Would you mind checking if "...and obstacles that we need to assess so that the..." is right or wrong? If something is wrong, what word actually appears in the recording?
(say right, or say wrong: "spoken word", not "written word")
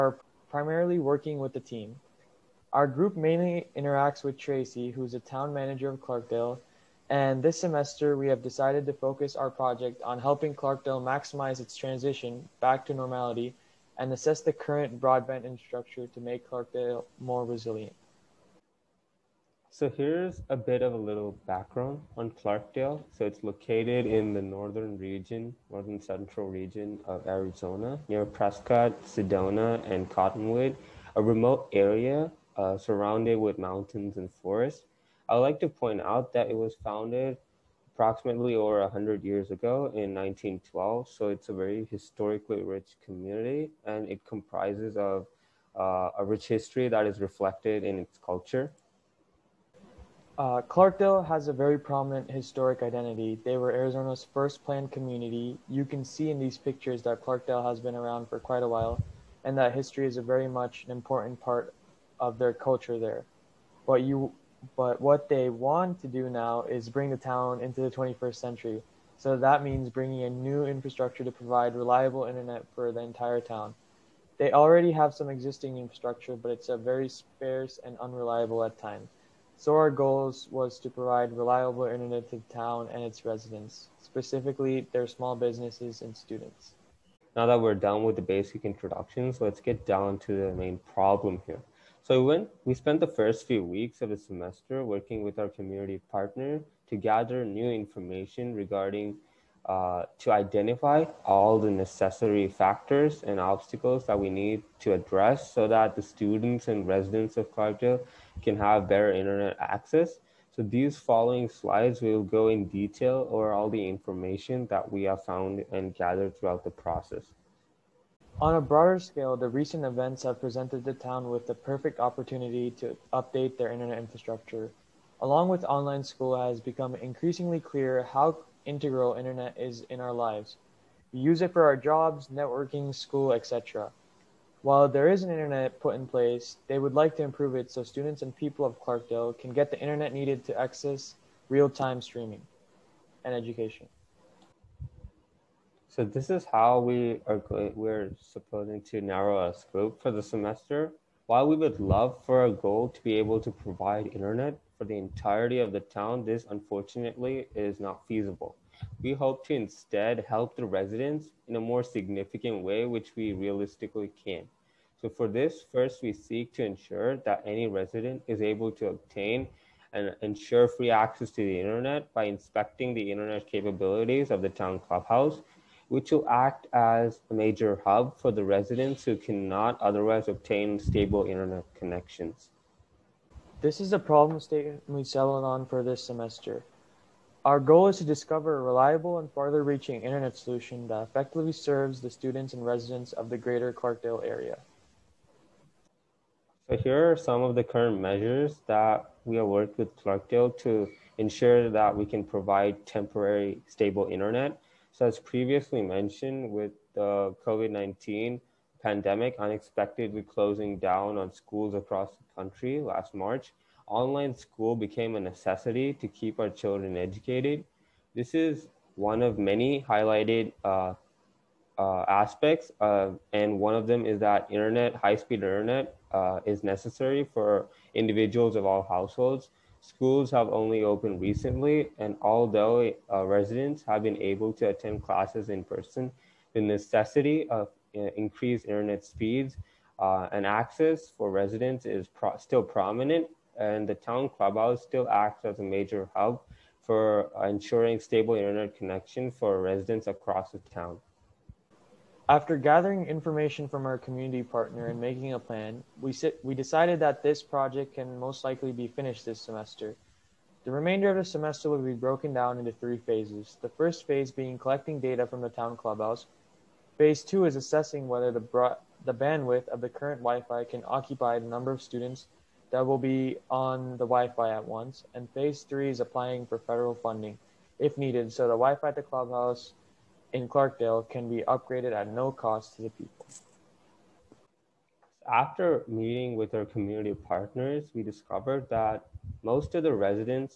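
wrong: "address", not "assess".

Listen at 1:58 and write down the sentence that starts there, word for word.
On a broader scale, the recent events have presented the town with the perfect opportunity to update their internet infrastructure.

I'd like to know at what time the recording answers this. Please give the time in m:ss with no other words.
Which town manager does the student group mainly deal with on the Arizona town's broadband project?
0:04.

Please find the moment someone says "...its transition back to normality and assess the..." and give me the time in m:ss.
0:11.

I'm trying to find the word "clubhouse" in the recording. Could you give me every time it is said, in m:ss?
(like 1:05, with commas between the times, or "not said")
2:54, 4:04, 4:25, 4:39.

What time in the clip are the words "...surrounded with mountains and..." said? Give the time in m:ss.
0:32.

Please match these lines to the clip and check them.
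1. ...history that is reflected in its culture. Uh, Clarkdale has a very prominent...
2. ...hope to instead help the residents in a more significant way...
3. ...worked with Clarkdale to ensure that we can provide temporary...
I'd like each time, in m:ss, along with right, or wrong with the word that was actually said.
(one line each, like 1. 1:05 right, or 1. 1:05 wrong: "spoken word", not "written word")
1. 0:46 right
2. 2:39 right
3. 3:19 right.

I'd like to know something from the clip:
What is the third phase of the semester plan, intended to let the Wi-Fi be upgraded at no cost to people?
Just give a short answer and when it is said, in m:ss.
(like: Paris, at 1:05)
applying for federal funding, at 4:35.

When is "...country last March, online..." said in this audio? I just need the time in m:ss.
3:32.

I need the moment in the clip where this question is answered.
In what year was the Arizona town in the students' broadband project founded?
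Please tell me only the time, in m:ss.
0:40.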